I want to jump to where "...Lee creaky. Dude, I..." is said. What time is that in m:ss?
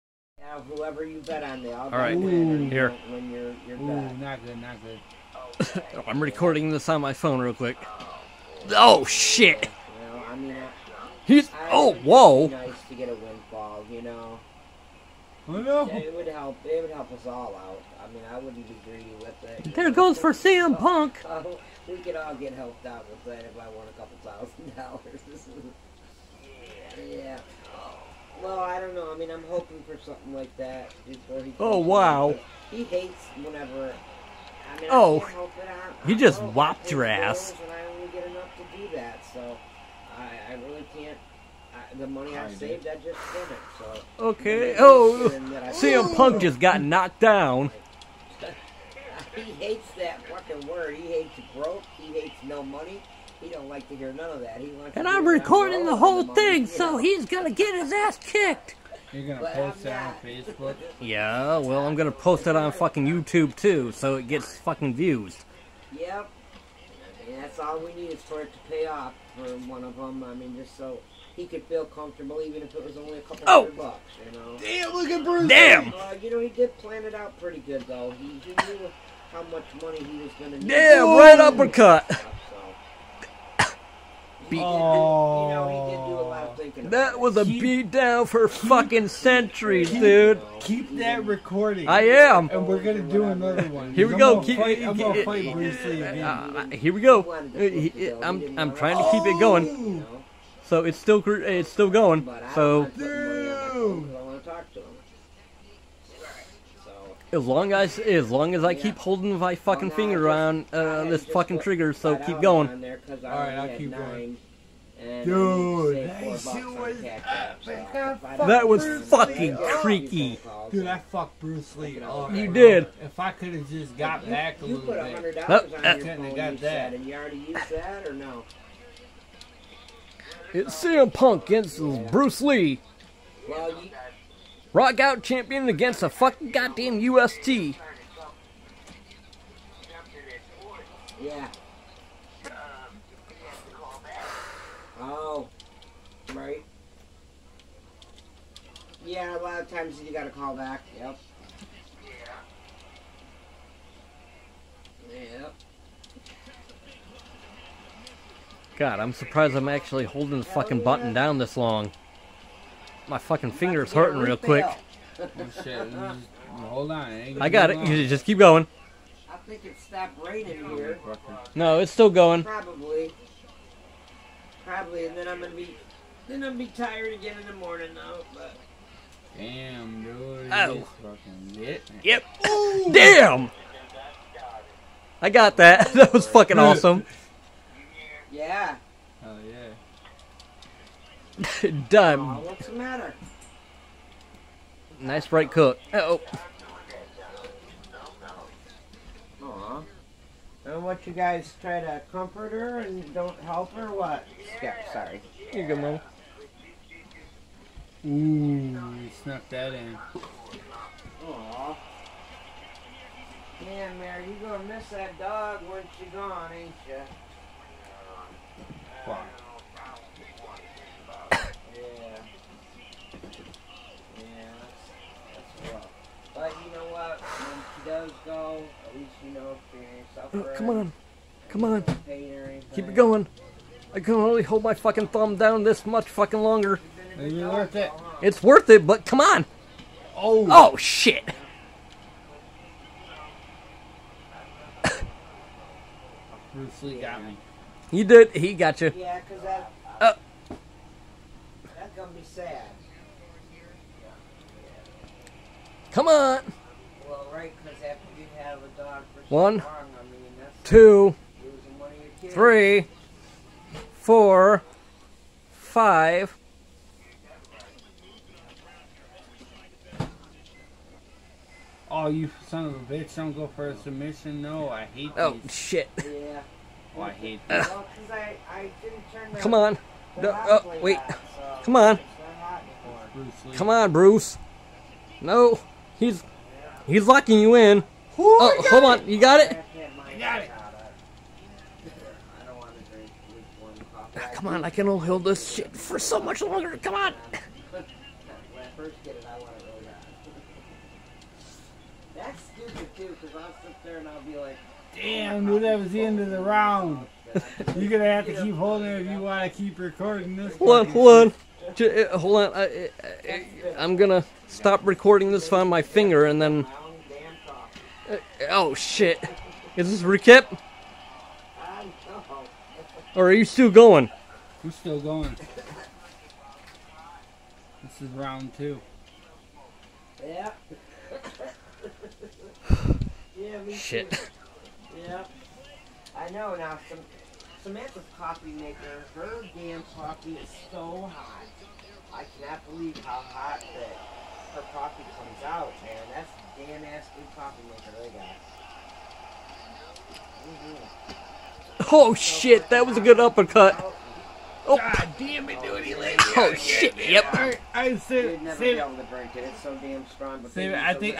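1:59.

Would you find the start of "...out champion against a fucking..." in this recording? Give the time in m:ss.
2:15.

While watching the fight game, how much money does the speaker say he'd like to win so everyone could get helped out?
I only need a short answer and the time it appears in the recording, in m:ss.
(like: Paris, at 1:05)
a couple thousand dollars, at 0:23.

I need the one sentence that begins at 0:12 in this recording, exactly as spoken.
Nice to get a windfall, you know.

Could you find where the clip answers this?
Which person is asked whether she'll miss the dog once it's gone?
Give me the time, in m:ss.
3:33.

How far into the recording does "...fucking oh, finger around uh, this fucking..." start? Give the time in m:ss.
1:49.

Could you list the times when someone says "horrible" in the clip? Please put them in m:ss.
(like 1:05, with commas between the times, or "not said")
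not said.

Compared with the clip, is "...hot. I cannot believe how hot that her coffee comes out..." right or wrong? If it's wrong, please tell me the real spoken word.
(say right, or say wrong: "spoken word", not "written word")
right.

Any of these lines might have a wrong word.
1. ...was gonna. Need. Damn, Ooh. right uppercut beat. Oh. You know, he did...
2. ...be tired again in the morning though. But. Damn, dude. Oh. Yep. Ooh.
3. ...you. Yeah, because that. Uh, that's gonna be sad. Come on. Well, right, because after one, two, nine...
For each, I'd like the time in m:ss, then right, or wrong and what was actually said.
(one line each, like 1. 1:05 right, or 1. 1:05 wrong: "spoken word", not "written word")
1. 1:20 wrong: "Whoa", not "Ooh"
2. 2:56 right
3. 4:08 wrong: "three", not "nine".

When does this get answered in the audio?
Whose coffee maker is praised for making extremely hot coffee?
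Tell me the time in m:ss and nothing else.
5:37.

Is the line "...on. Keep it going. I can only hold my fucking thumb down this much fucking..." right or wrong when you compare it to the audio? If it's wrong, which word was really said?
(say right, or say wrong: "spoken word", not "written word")
right.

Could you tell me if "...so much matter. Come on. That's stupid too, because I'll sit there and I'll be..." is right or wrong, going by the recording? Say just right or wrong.
wrong.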